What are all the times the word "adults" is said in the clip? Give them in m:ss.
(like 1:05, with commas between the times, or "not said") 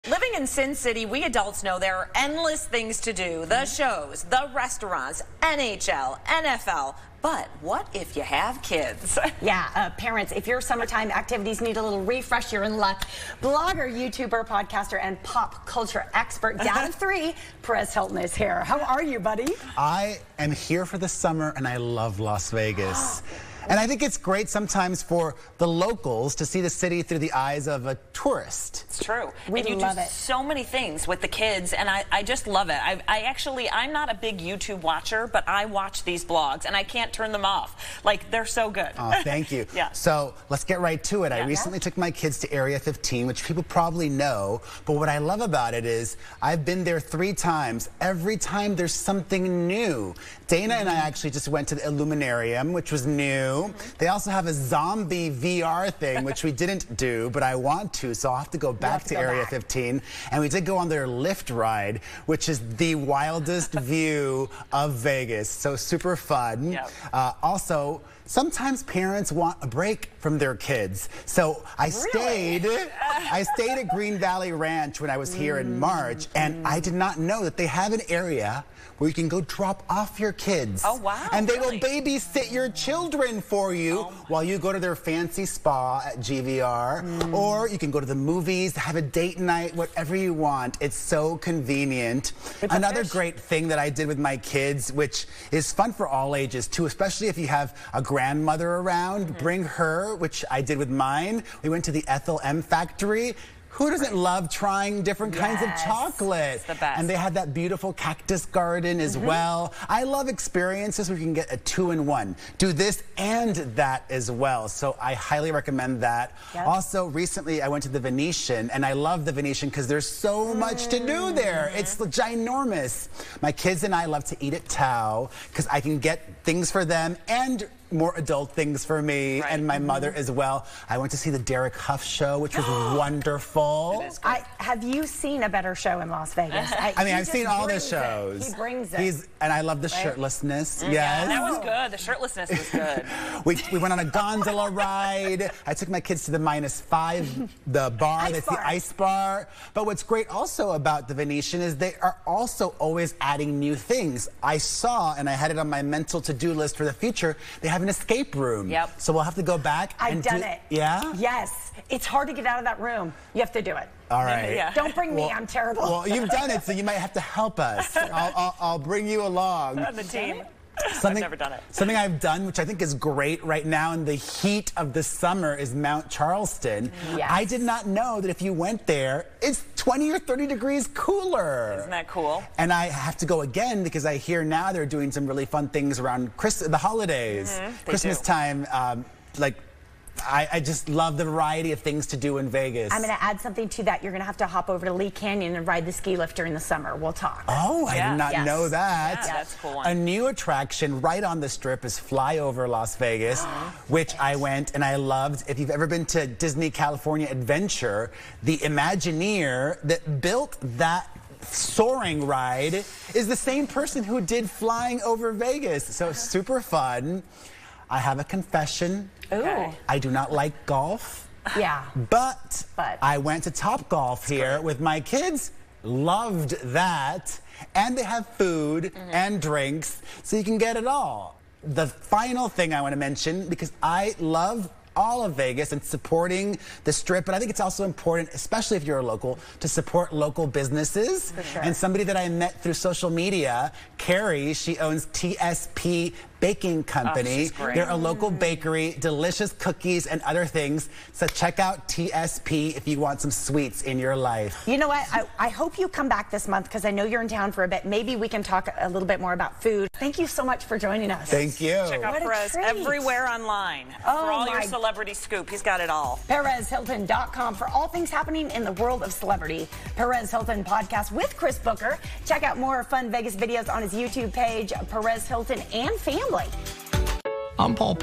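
0:01, 2:08.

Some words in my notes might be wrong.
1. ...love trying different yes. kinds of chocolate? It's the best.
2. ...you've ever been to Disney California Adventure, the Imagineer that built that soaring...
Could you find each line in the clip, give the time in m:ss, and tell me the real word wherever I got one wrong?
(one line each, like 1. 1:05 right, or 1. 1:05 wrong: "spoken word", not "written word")
1. 1:44 right
2. 3:25 right.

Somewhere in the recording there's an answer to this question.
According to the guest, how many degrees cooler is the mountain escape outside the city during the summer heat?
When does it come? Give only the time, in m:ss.
2:59.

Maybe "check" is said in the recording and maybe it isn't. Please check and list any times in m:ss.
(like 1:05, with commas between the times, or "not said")
4:11, 4:21, 4:32.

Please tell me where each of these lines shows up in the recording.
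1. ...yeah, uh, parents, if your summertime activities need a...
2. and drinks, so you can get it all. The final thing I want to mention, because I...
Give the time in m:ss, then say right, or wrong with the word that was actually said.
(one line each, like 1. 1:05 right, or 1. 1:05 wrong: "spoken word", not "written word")
1. 0:09 right
2. 3:49 right.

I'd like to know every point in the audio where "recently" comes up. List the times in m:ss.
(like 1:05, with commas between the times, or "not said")
0:41, 1:57.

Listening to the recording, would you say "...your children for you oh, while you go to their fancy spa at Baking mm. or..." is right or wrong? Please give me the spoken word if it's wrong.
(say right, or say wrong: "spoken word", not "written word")
wrong: "GVR", not "Baking".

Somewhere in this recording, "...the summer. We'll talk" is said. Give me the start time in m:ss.
3:16.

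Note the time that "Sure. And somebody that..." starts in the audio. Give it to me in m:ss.
4:01.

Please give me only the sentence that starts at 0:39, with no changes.
So let's get right to it.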